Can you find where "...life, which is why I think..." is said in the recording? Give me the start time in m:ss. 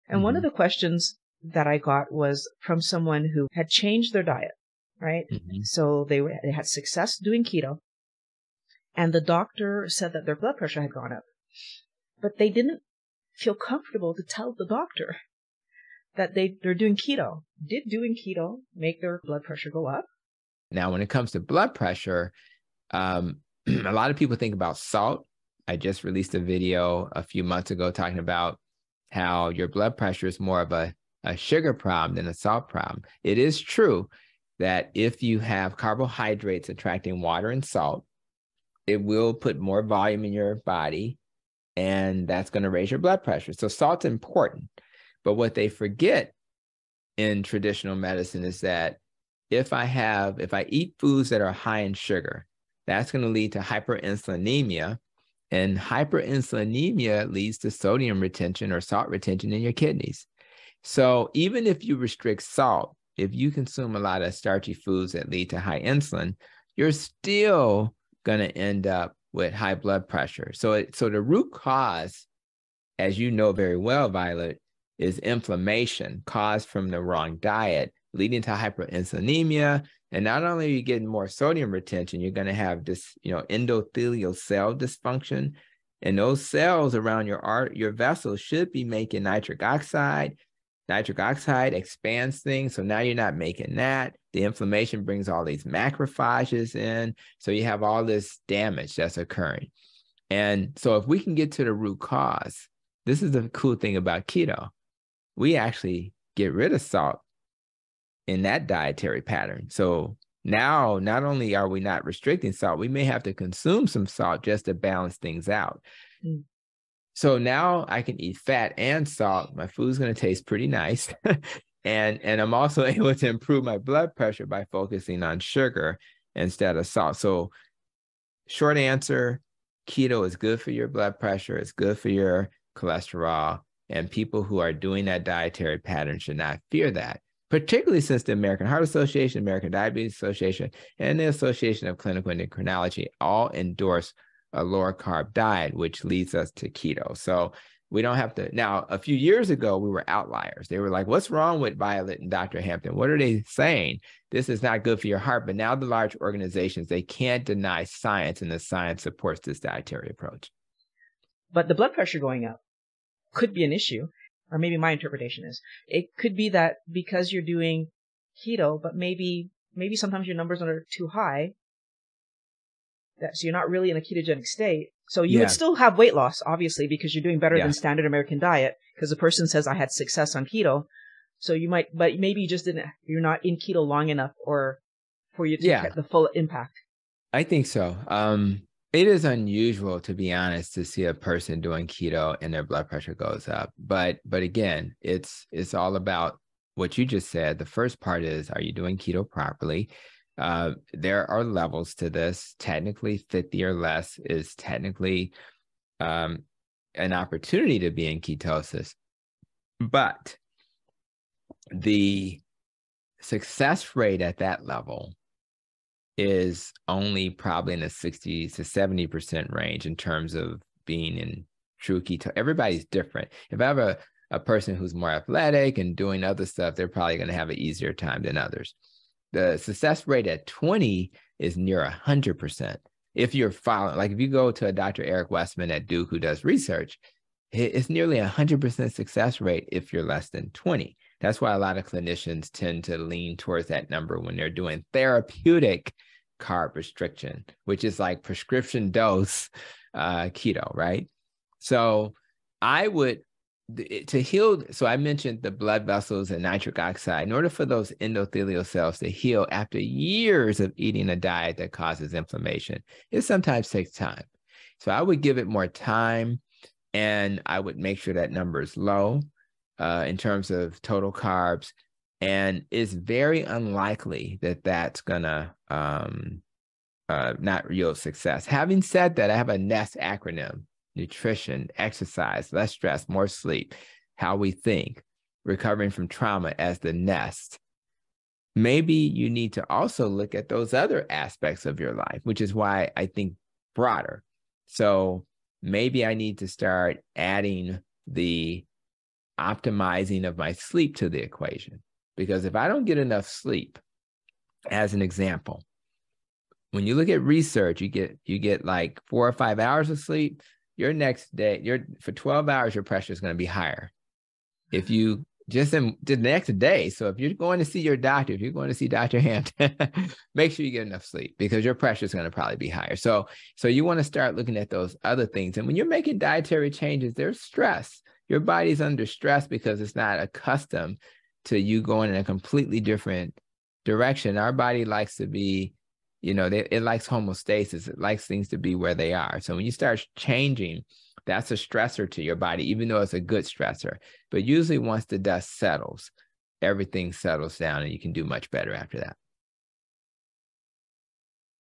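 4:51.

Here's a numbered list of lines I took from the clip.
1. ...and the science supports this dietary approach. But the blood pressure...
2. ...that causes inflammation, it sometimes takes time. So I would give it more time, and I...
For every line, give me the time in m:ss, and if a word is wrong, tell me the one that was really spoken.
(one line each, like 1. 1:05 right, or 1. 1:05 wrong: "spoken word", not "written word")
1. 2:38 right
2. 4:21 right.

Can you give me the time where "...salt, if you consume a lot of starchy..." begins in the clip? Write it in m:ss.
1:02.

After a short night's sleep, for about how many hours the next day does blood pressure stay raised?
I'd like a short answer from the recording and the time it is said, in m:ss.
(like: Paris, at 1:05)
12, at 5:12.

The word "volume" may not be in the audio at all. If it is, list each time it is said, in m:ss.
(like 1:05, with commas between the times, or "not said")
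0:39.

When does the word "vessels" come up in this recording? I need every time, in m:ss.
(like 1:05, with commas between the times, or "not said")
1:27, 4:15.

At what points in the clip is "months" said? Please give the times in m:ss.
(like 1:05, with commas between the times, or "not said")
0:27.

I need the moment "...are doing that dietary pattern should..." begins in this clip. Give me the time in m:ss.
2:14.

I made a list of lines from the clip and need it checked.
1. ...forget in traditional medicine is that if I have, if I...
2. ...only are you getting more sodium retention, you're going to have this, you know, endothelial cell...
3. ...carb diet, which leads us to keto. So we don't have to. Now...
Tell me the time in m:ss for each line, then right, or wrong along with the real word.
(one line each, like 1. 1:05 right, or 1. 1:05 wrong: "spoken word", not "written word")
1. 0:45 right
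2. 1:20 right
3. 2:24 right.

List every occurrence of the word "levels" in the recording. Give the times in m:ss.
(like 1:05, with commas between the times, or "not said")
3:21, 3:34.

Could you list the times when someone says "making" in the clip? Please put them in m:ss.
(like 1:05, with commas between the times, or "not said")
1:28, 1:33, 5:25.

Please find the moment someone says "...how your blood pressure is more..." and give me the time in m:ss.
0:29.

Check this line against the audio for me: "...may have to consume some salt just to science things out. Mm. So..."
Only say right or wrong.
wrong.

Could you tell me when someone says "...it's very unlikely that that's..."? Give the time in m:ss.
4:32.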